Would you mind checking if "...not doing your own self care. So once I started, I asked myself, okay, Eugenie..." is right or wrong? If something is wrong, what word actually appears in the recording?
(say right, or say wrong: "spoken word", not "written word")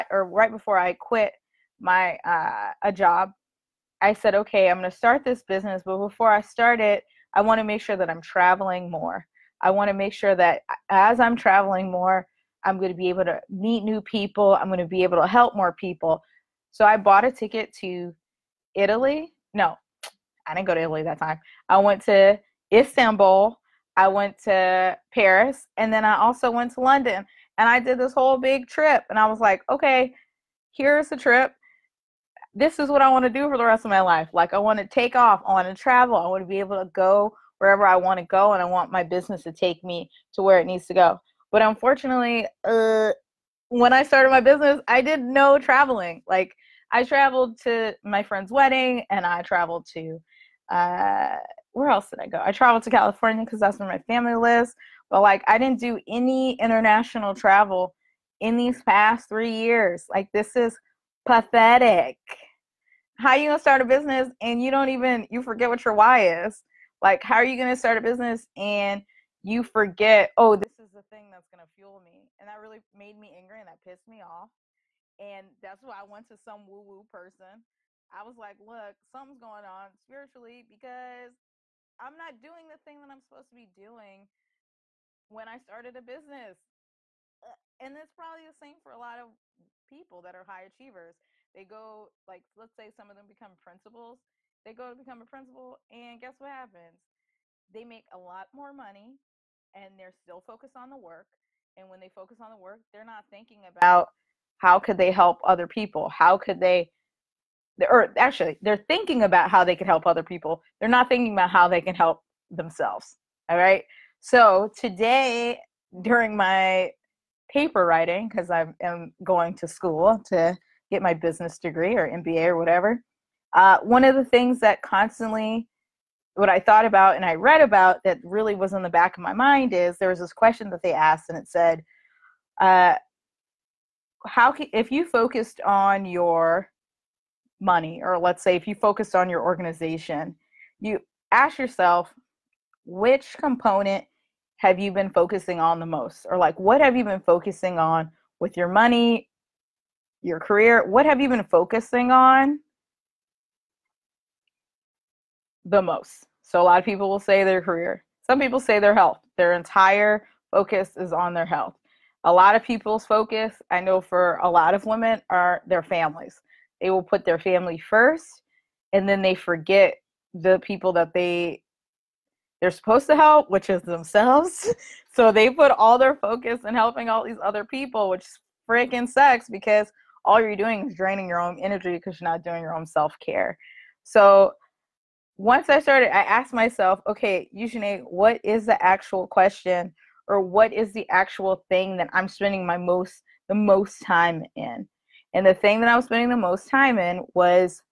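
right.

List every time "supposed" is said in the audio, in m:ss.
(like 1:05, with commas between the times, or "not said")
1:23, 2:52.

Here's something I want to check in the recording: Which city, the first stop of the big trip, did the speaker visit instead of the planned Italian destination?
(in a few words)
Istanbul.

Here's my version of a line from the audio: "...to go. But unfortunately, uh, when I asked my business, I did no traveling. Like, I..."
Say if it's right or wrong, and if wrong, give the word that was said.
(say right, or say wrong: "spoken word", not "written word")
wrong: "started", not "asked".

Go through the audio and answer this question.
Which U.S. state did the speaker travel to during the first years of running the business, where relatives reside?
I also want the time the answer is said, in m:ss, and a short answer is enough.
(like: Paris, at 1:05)
California, at 0:52.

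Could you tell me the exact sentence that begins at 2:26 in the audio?
Or like, what have you been focusing on with your money, your career?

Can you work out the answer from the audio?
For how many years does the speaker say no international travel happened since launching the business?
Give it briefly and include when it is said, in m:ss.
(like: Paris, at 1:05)
3, at 0:59.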